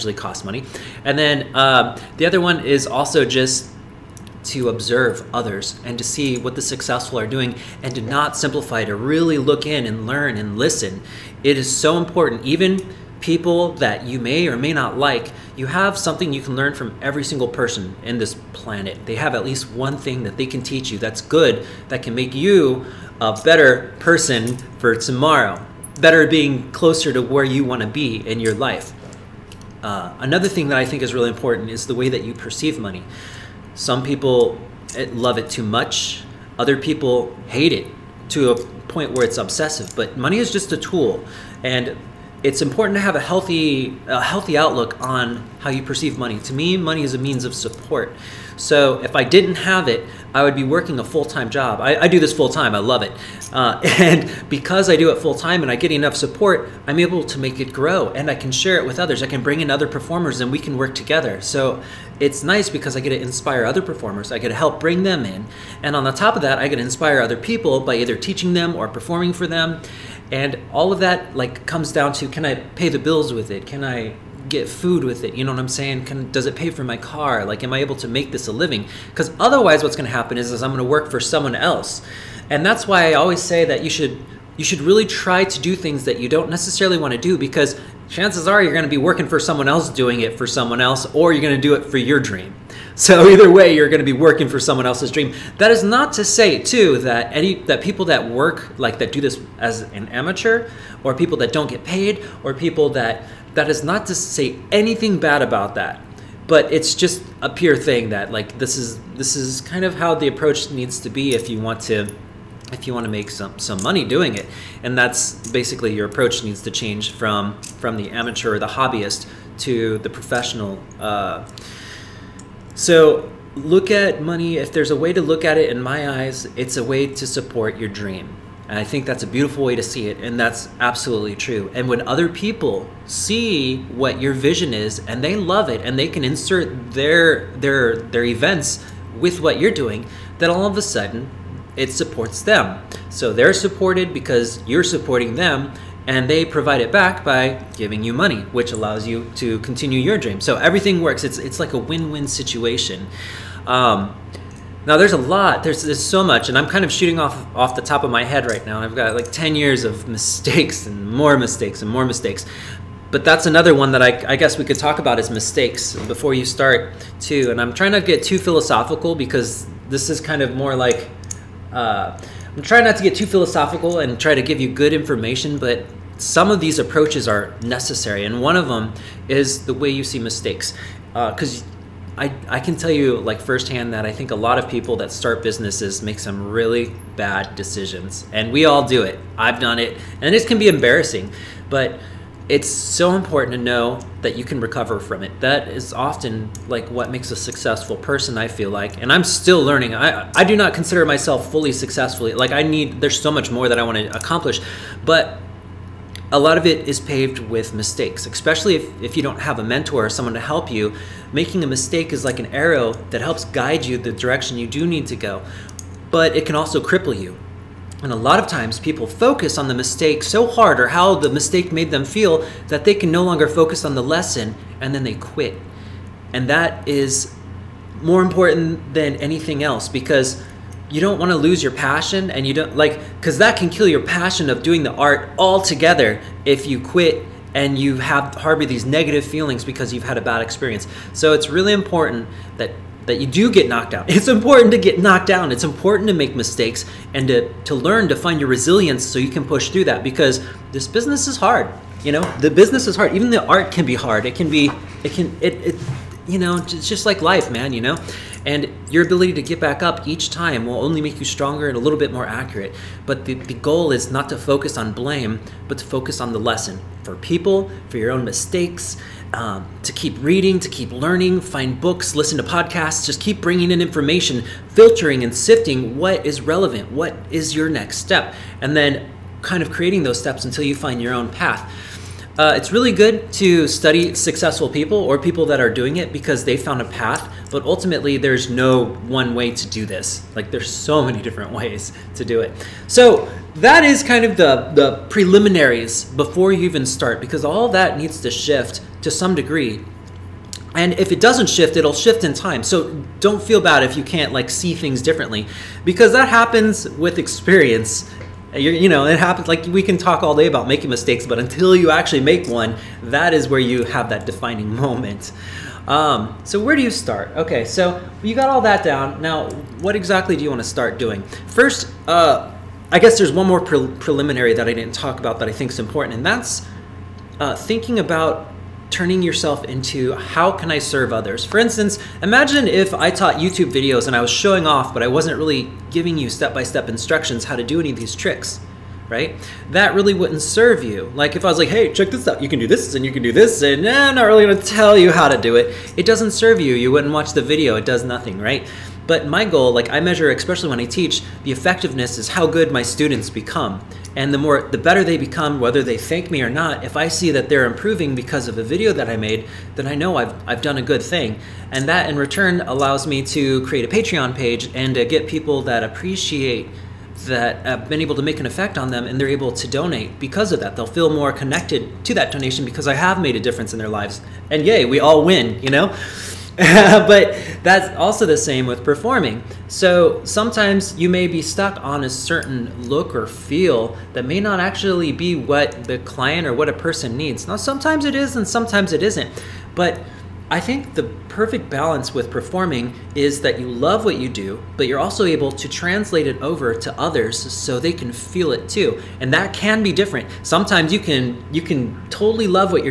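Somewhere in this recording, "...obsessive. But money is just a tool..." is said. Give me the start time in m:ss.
0:39.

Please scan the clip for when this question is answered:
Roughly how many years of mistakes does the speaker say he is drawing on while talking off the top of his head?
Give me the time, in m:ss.
2:39.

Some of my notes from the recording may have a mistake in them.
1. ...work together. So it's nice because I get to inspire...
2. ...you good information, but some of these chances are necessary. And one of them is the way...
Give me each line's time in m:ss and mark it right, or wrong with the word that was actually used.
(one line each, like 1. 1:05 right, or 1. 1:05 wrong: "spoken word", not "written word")
1. 1:00 right
2. 2:54 wrong: "approaches", not "chances".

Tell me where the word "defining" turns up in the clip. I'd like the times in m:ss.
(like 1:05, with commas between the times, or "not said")
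5:14.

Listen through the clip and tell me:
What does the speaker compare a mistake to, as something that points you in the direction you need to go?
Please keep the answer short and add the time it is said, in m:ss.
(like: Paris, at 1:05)
an arrow, at 3:32.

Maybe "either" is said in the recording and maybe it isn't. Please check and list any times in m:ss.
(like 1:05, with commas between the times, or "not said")
1:07, 1:33.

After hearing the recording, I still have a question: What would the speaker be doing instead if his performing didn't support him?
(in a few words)
a full time job.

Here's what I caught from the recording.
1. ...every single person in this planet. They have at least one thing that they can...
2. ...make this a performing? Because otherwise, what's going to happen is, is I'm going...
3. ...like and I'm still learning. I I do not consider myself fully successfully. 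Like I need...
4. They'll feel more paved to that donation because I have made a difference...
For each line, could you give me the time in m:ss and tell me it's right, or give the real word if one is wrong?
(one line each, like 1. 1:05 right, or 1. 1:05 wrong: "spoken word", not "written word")
1. 0:17 right
2. 1:18 wrong: "living", not "performing"
3. 3:18 right
4. 6:10 wrong: "connected", not "paved".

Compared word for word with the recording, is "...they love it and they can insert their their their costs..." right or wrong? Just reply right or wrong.
wrong.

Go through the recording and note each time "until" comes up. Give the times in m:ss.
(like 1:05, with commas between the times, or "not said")
4:40, 5:11.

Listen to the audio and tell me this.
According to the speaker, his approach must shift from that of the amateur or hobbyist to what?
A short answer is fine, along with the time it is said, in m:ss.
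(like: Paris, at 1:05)
the professional, at 1:59.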